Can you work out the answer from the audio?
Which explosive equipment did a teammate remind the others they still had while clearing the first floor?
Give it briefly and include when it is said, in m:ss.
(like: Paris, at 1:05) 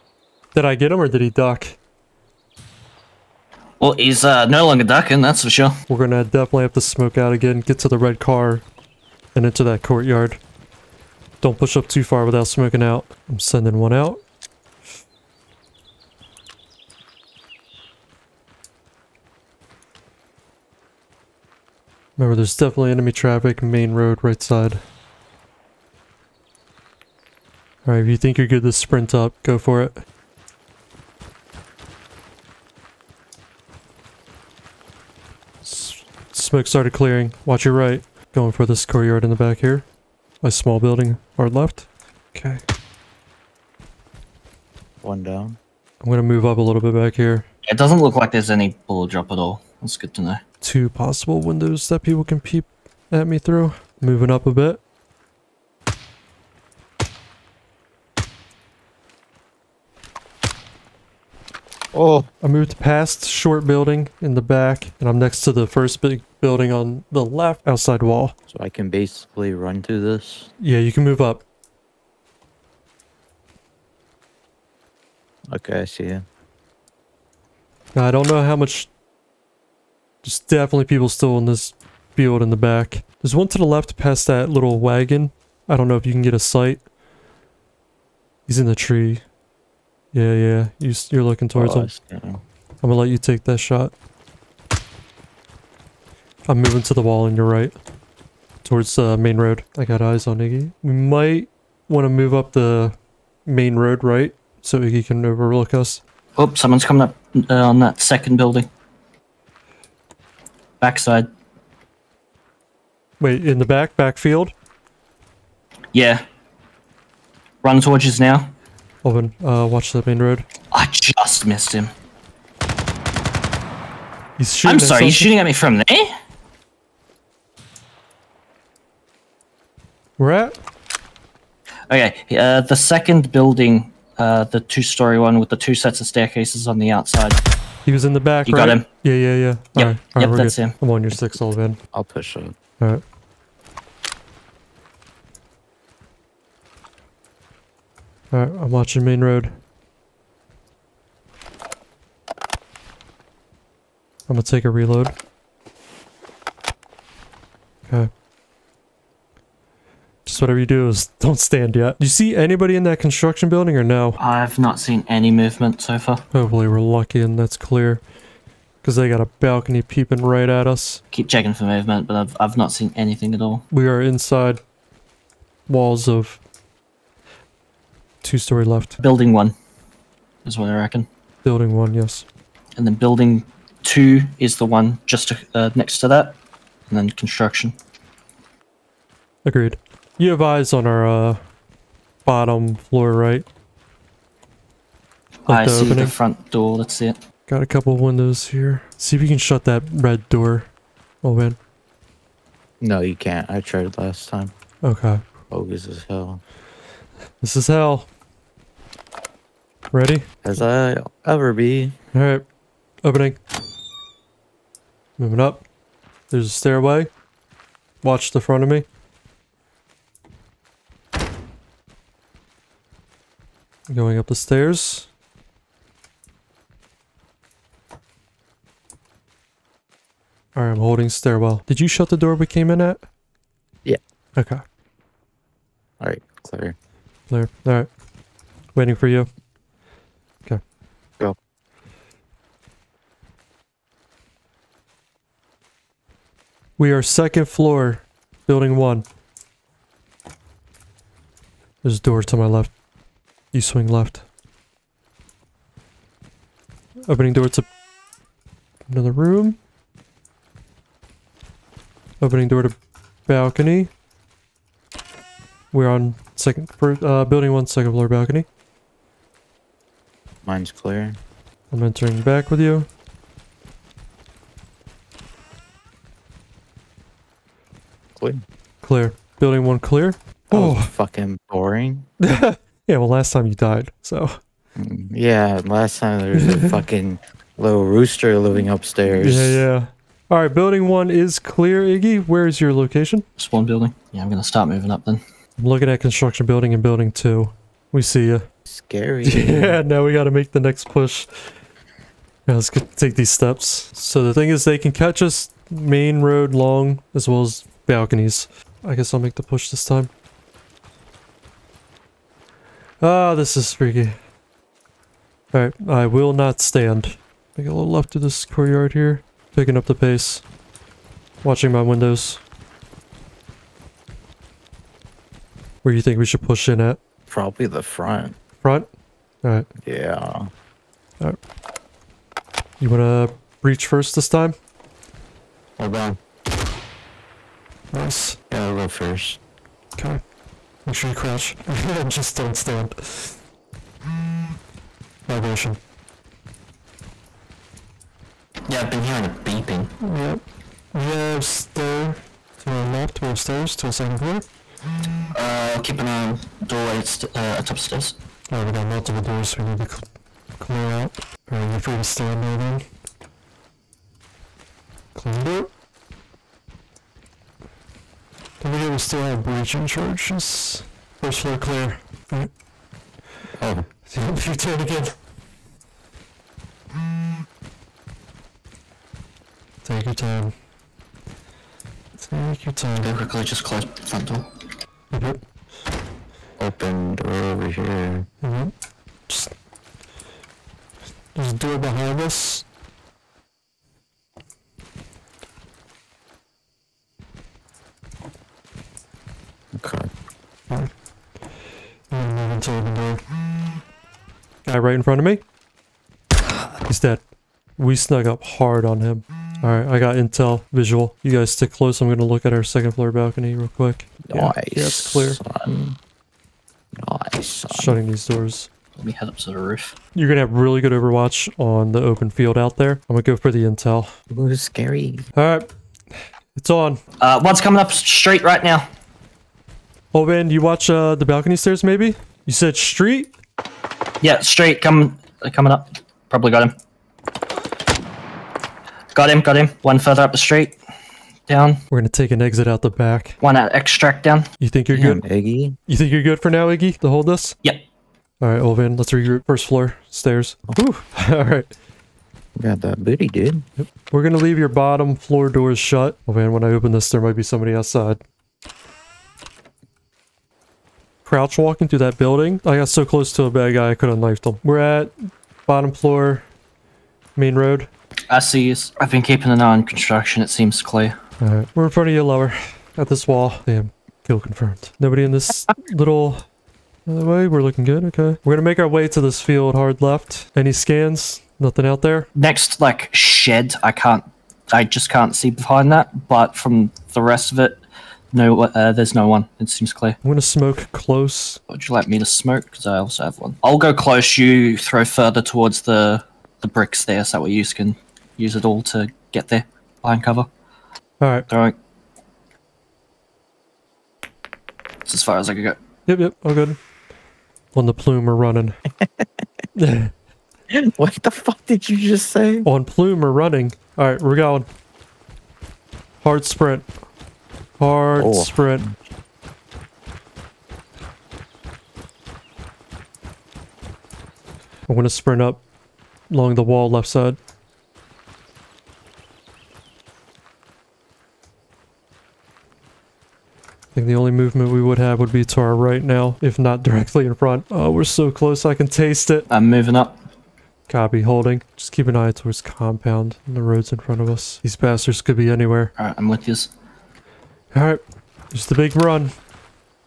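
breaching charges, at 6:09.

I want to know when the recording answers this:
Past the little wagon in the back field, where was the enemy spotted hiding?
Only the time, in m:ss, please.
1:28.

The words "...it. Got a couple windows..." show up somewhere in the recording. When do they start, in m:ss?
3:17.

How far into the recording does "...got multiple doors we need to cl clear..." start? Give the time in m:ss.
5:58.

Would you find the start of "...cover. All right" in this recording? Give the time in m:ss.
8:20.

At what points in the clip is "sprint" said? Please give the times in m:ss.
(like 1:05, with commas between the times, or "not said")
0:28, 8:36, 8:45.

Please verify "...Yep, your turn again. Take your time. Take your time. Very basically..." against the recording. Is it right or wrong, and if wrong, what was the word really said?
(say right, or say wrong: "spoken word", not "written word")
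wrong: "quickly", not "basically".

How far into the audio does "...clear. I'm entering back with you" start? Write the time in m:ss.
4:30.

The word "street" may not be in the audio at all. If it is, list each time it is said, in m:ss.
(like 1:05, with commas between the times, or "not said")
7:12, 7:20.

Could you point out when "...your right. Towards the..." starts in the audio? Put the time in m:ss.
1:37.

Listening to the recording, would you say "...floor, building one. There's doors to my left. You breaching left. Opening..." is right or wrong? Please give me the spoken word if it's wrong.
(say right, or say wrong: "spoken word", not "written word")
wrong: "swing", not "breaching".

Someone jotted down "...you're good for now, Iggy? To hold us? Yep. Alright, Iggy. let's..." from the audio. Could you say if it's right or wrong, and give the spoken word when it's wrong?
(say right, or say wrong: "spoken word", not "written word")
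wrong: "Ohlvann", not "Iggy".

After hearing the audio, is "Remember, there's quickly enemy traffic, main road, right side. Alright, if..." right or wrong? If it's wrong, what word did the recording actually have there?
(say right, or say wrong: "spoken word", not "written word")
wrong: "definitely", not "quickly".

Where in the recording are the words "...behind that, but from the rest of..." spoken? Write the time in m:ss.
8:05.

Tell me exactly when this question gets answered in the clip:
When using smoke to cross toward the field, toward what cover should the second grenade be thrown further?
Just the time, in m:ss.
8:16.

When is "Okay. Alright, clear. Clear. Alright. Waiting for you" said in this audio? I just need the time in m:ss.
3:54.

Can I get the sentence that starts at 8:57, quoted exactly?
Oh, we're so close, I can taste it.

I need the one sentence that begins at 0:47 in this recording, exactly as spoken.
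It doesn't look like there's any bullet drop at all.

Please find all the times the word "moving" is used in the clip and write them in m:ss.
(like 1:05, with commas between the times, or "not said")
0:53, 1:36, 3:35, 4:54, 8:59.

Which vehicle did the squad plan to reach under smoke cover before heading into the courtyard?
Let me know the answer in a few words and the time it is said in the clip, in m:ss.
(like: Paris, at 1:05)
the red car, at 0:07.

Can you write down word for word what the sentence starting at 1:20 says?
There's definitely people still in this field in the back.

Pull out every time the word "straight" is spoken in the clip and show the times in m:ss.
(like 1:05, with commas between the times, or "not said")
7:07, 7:14.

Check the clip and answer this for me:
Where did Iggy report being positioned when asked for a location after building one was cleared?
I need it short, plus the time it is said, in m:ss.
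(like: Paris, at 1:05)
Spawn one building, at 4:53.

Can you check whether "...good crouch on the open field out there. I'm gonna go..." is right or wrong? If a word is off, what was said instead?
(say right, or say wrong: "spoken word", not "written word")
wrong: "overwatch", not "crouch".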